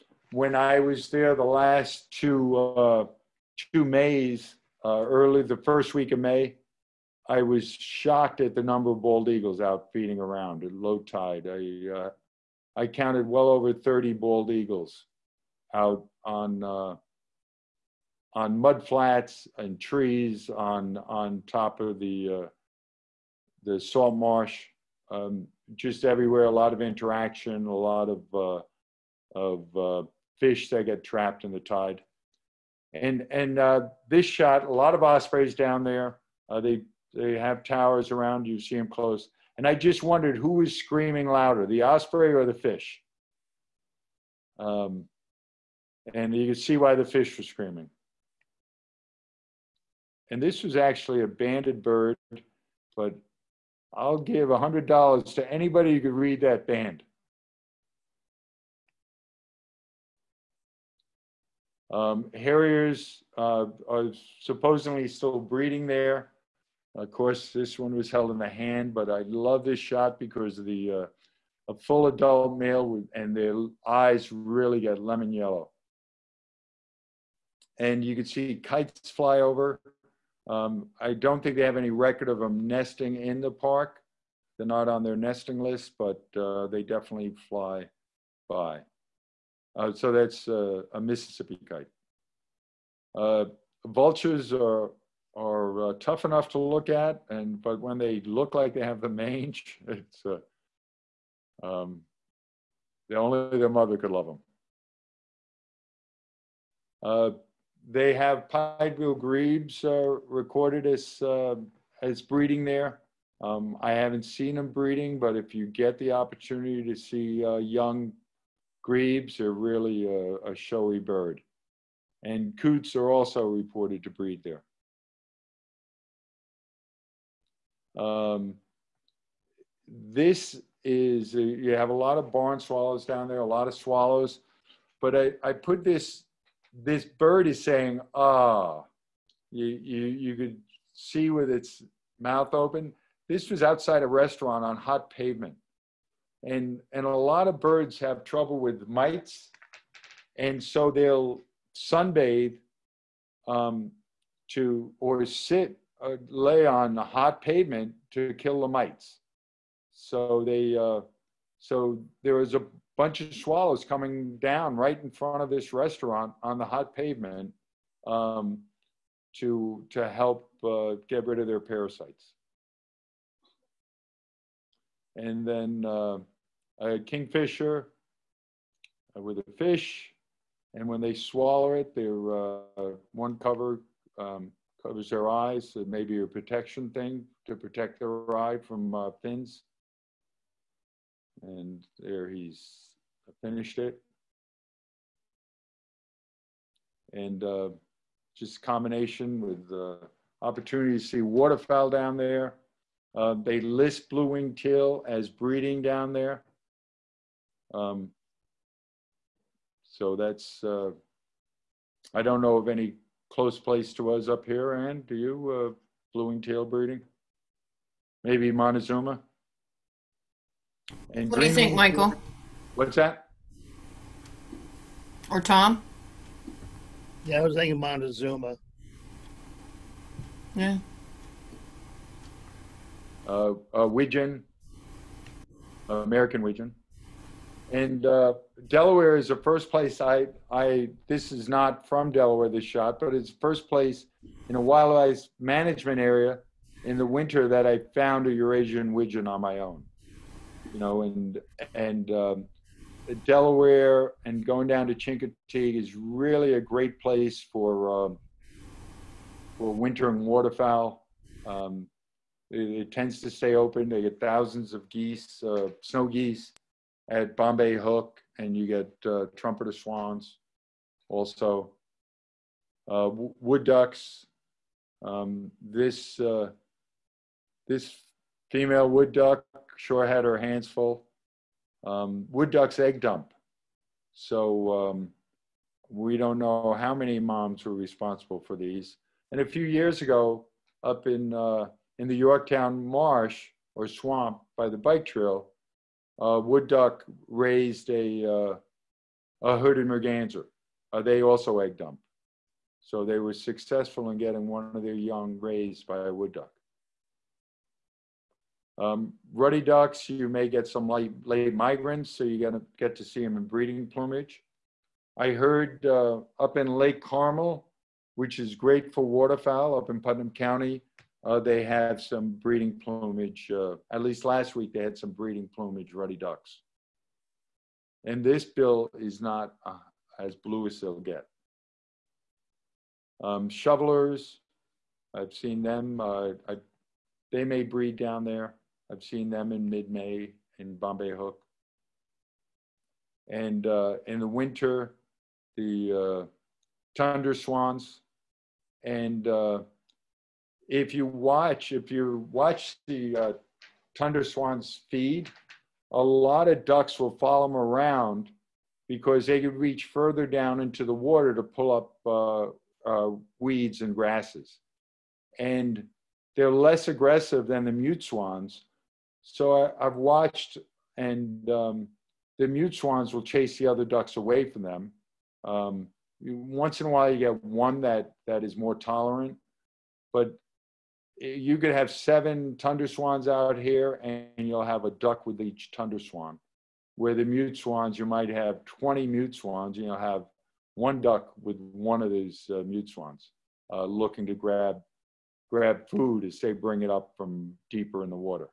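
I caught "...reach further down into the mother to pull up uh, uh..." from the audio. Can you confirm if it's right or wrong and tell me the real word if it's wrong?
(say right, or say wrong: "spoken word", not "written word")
wrong: "water", not "mother".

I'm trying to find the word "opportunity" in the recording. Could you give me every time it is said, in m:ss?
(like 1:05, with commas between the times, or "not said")
1:56, 3:20.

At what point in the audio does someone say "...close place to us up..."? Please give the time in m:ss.
3:33.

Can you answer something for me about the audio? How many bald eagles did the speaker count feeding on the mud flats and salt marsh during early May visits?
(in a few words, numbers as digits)
over 30.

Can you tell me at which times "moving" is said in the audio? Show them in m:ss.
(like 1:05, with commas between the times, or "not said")
not said.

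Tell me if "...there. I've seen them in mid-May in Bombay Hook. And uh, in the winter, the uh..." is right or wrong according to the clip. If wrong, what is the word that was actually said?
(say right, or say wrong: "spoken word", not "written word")
right.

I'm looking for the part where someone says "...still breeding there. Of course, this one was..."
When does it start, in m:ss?
1:05.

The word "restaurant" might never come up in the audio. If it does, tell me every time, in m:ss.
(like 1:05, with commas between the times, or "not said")
2:24, 2:45.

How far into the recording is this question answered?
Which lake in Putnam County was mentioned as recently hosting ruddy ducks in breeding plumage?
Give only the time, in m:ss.
5:16.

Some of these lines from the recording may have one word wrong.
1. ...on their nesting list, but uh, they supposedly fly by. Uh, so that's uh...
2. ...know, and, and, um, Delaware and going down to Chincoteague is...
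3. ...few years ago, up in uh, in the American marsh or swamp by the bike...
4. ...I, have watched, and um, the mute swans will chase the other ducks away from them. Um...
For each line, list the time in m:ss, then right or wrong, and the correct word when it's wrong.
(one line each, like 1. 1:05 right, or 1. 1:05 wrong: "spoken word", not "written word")
1. 1:24 wrong: "definitely", not "supposedly"
2. 4:10 right
3. 4:49 wrong: "Yorktown", not "American"
4. 6:09 right.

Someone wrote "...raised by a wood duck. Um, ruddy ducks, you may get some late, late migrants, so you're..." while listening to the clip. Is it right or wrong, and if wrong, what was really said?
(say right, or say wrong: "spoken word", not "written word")
right.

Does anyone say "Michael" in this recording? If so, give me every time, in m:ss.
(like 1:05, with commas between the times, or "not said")
3:41.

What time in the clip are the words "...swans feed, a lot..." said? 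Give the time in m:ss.
5:54.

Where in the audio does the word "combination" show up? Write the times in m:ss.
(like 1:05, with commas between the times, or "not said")
3:18.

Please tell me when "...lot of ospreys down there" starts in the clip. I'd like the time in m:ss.
0:34.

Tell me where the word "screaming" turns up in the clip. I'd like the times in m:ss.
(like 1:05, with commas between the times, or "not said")
0:40, 0:47.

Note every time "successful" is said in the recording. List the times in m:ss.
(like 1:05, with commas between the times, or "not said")
5:03.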